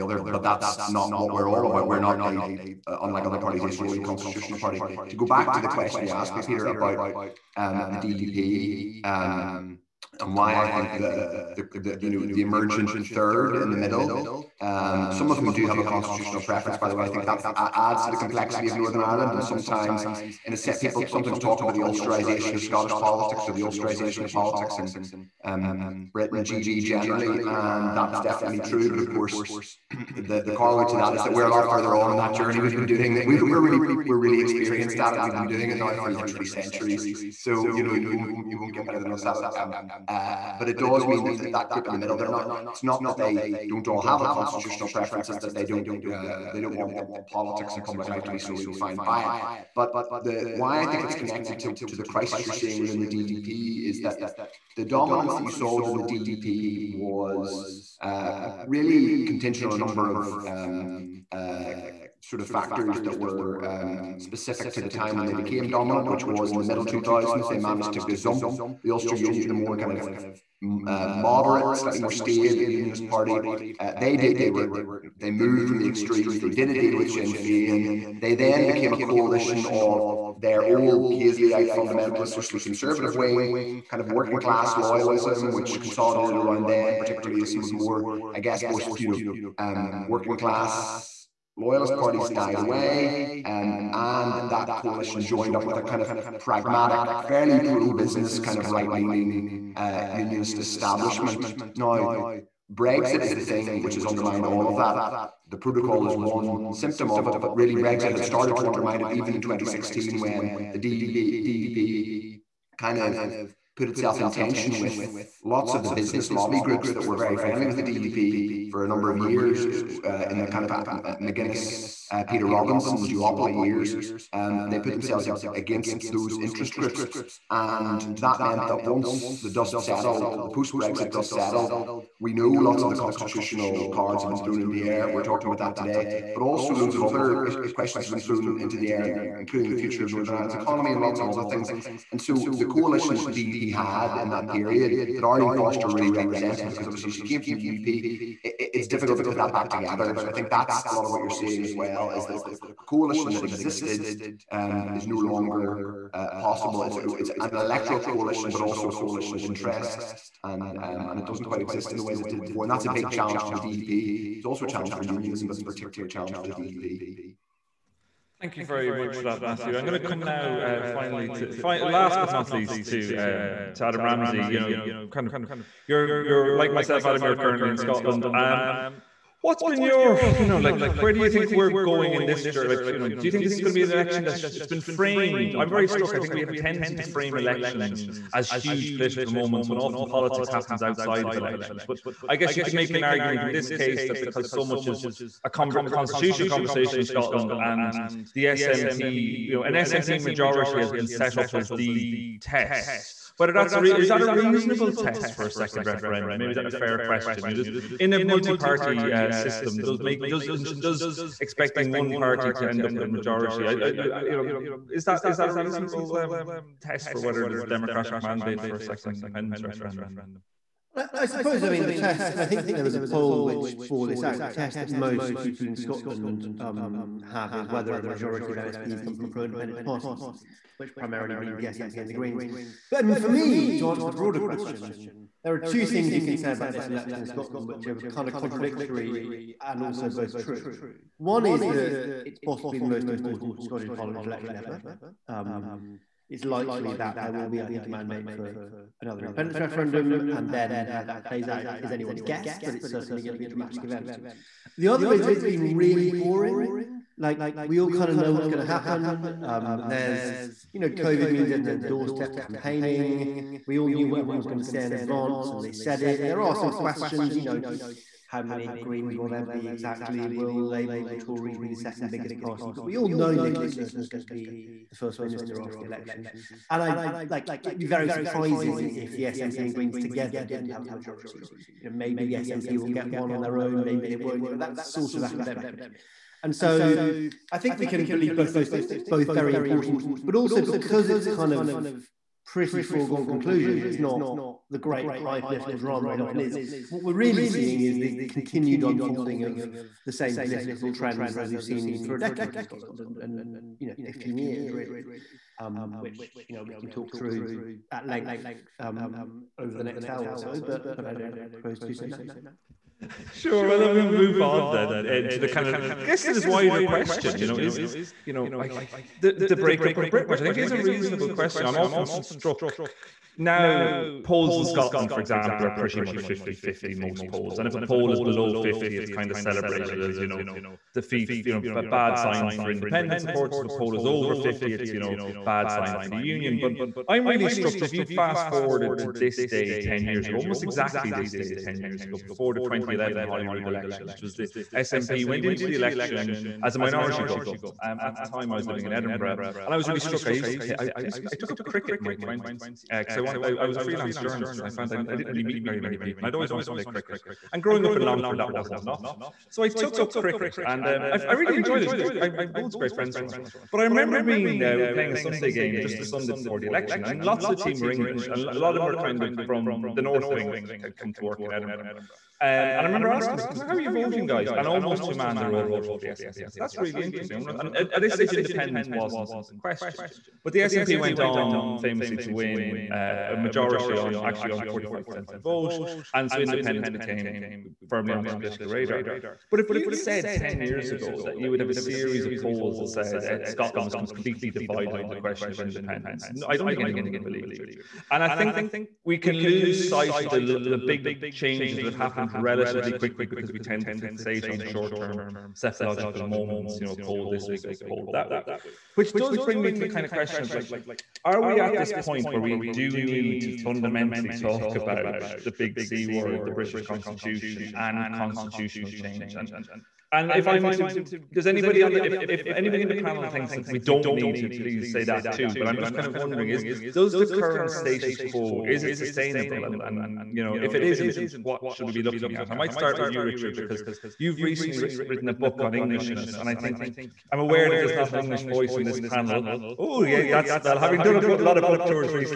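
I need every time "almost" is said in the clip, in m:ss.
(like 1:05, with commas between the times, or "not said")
5:40, 6:14.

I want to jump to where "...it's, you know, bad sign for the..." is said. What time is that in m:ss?
5:34.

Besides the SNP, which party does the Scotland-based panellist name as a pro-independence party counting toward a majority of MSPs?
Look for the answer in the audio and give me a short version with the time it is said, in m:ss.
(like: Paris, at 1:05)
the Greens, at 3:52.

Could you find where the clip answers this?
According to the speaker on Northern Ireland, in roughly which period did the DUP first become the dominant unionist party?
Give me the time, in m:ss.
1:06.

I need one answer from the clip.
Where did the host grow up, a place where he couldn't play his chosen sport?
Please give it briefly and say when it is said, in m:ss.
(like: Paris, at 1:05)
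Longford, at 5:58.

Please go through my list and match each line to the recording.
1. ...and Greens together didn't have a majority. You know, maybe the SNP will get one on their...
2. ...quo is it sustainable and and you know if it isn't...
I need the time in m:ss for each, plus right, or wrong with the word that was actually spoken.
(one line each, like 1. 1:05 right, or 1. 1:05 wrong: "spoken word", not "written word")
1. 4:39 right
2. 7:08 right.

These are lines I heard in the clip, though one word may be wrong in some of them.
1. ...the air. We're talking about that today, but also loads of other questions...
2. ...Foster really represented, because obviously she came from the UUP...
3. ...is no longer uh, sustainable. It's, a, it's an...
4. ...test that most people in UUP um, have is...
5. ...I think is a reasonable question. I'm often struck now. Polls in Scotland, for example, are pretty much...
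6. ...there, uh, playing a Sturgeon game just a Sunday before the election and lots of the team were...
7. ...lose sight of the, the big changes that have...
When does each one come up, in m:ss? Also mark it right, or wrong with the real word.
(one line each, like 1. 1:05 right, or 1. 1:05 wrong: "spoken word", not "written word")
1. 2:14 right
2. 2:25 right
3. 2:34 wrong: "possible", not "sustainable"
4. 3:44 wrong: "Scotland", not "UUP"
5. 5:20 right
6. 6:04 wrong: "Sunday", not "Sturgeon"
7. 6:39 right.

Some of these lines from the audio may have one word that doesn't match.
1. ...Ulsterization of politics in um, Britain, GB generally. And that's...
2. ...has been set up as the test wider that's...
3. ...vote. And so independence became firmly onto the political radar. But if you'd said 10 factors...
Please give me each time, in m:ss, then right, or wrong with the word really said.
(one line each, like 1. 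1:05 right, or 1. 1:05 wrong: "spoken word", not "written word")
1. 0:23 right
2. 3:20 wrong: "whether", not "wider"
3. 6:25 wrong: "years", not "factors".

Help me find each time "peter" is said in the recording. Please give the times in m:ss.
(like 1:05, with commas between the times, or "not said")
0:06, 2:02.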